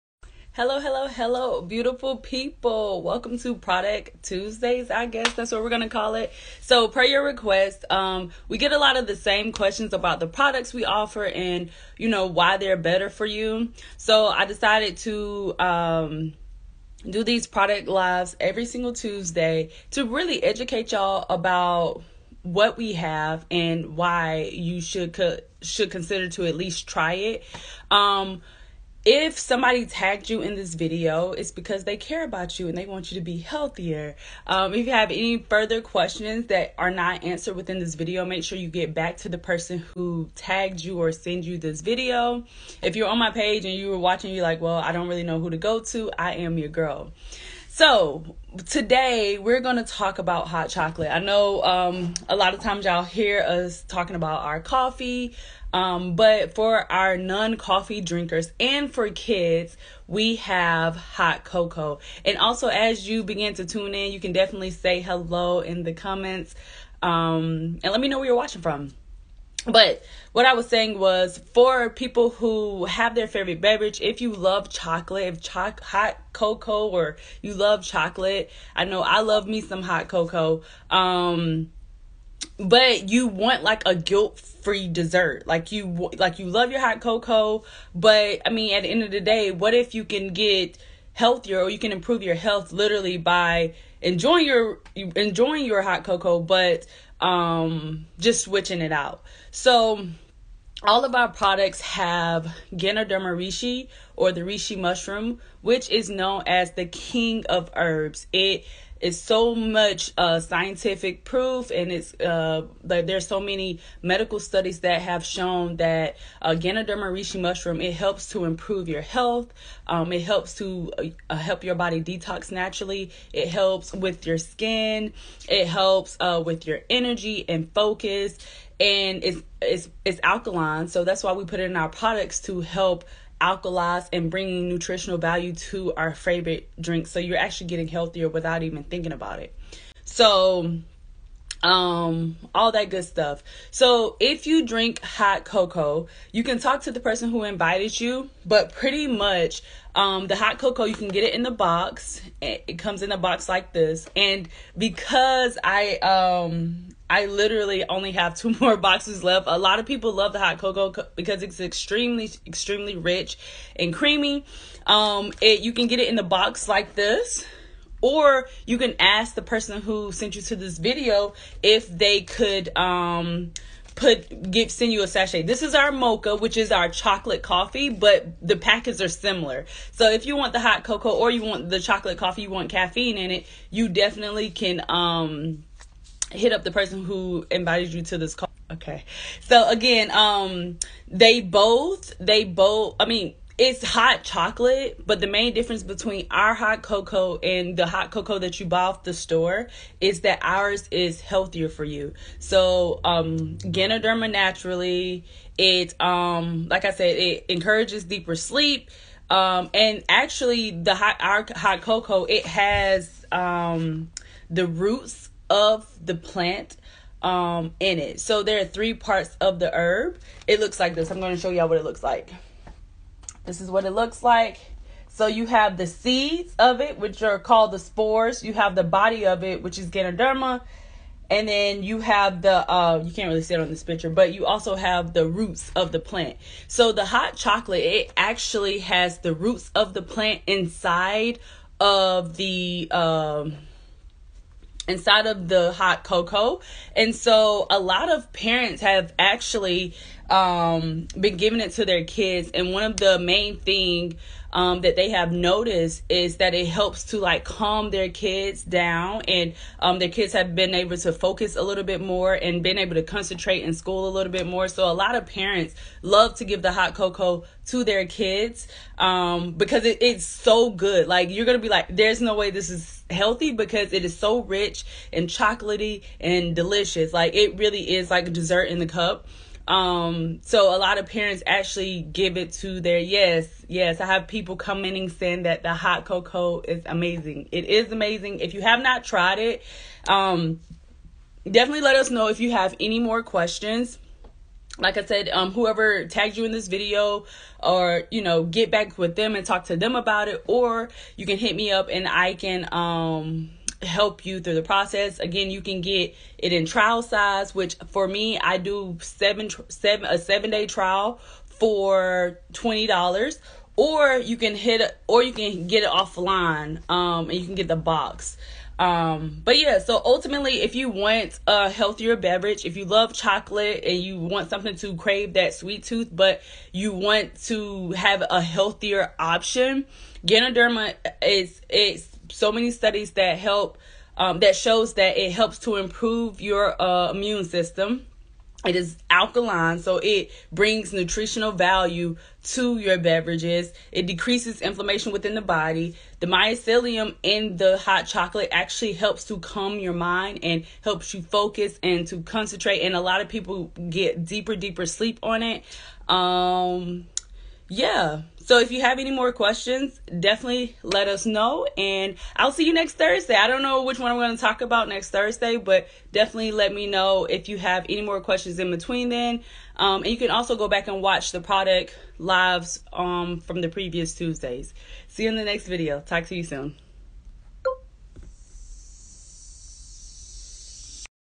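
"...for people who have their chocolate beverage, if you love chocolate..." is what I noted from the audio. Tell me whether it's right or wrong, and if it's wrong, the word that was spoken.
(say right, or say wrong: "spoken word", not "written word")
wrong: "favorite", not "chocolate".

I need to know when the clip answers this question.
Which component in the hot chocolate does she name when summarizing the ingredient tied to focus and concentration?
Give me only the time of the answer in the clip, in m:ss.
5:46.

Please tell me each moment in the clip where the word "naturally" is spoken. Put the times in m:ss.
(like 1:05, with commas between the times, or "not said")
2:02, 3:24.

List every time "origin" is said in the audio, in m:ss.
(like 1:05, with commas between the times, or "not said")
not said.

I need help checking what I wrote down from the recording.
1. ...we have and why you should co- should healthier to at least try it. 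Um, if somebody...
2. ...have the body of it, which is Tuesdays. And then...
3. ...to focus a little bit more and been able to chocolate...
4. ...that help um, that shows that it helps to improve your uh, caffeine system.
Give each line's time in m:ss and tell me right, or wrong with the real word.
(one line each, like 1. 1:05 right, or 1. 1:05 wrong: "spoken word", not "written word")
1. 0:22 wrong: "consider", not "healthier"
2. 3:48 wrong: "Ganoderma", not "Tuesdays"
3. 4:20 wrong: "concentrate", not "chocolate"
4. 5:33 wrong: "immune", not "caffeine".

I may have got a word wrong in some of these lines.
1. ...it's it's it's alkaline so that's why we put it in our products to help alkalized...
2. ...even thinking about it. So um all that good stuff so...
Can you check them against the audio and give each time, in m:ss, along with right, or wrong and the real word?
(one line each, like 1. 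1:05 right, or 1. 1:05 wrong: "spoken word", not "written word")
1. 2:09 right
2. 2:18 right.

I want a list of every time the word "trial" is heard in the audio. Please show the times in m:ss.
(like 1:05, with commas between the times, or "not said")
5:06, 5:10.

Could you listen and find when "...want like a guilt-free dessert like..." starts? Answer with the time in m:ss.
1:23.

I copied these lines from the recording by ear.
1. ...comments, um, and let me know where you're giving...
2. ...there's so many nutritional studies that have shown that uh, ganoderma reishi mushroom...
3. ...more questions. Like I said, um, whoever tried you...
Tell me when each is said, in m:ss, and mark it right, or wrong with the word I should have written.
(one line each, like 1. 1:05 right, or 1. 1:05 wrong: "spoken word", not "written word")
1. 1:05 wrong: "watching", not "giving"
2. 1:52 wrong: "medical", not "nutritional"
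3. 4:52 wrong: "tagged", not "tried".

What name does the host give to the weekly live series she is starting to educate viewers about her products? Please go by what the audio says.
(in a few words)
Product Tuesdays.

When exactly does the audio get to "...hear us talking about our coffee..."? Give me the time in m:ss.
0:53.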